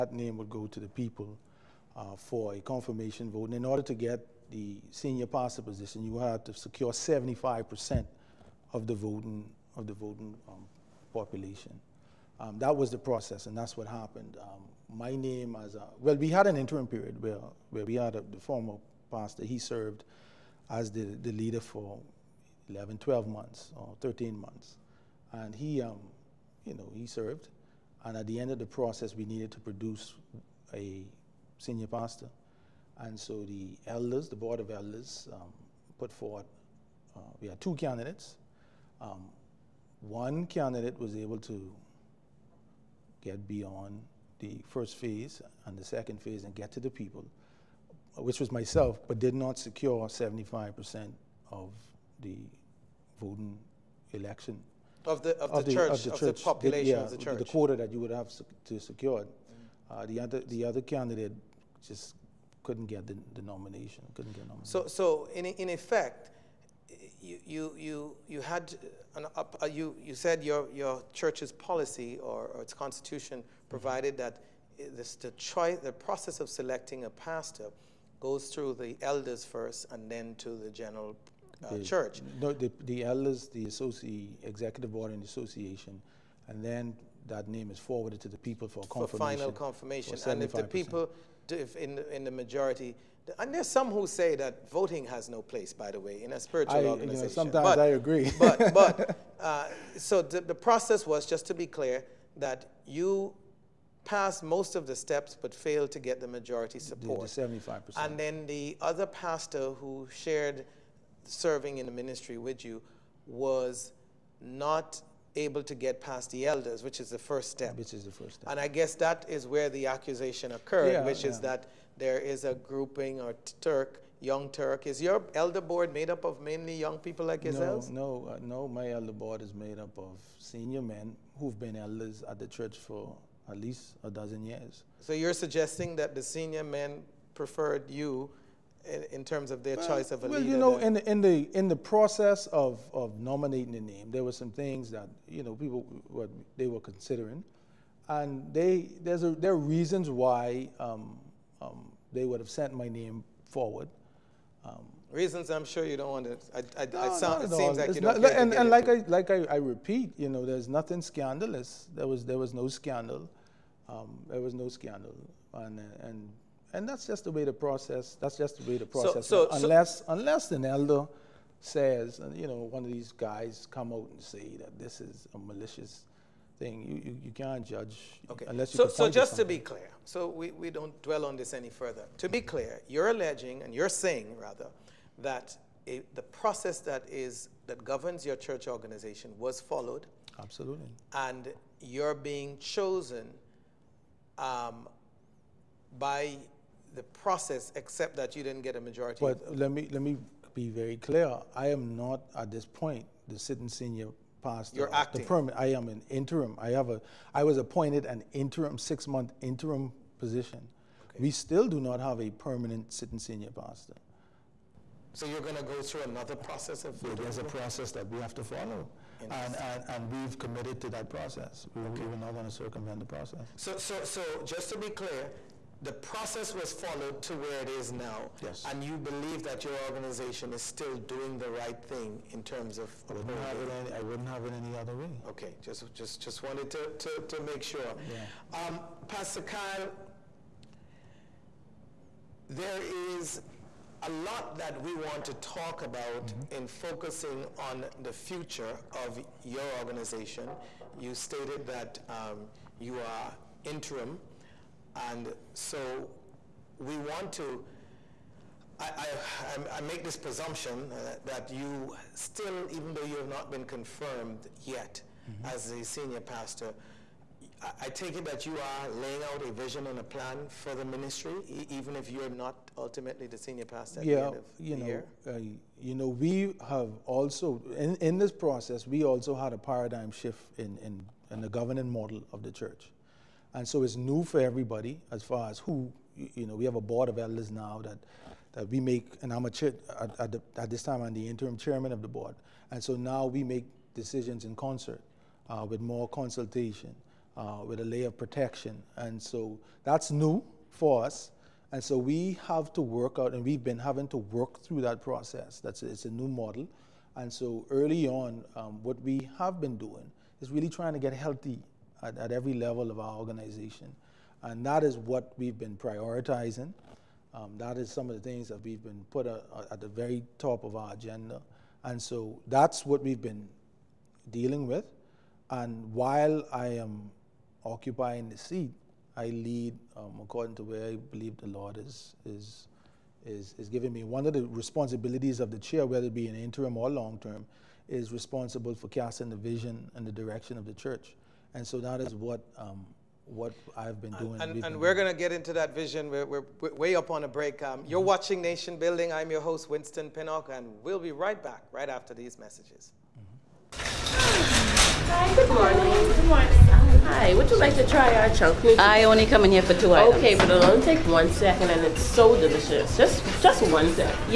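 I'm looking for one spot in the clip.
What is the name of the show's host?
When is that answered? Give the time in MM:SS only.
05:49.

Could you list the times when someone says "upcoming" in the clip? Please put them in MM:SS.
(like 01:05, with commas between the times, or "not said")
not said.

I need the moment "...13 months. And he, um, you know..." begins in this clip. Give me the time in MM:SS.
00:24.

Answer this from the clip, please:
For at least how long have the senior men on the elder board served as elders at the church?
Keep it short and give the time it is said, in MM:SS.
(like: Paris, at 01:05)
a dozen years, at 02:14.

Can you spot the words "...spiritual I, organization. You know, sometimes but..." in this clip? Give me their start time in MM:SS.
01:36.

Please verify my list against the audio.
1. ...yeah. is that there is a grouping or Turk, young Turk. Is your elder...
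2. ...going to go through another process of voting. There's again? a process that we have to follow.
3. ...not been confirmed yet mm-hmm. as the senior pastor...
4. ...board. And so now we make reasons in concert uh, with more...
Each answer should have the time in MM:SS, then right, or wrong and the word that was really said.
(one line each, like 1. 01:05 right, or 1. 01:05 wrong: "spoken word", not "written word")
1. 02:01 right
2. 03:35 right
3. 04:23 right
4. 04:52 wrong: "decisions", not "reasons".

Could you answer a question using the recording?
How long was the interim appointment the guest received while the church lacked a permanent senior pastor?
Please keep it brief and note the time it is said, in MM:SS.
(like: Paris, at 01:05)
6 months, at 03:28.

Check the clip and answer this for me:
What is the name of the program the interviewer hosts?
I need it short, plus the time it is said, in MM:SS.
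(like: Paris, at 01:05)
Nation Building, at 05:48.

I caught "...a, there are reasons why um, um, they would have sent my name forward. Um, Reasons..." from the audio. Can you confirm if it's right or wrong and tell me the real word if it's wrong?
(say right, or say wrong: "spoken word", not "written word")
right.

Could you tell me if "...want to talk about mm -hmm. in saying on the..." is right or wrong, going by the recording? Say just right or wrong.
wrong.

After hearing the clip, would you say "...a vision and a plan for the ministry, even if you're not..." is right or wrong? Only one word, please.
right.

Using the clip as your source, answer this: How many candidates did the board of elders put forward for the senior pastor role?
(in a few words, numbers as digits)
2.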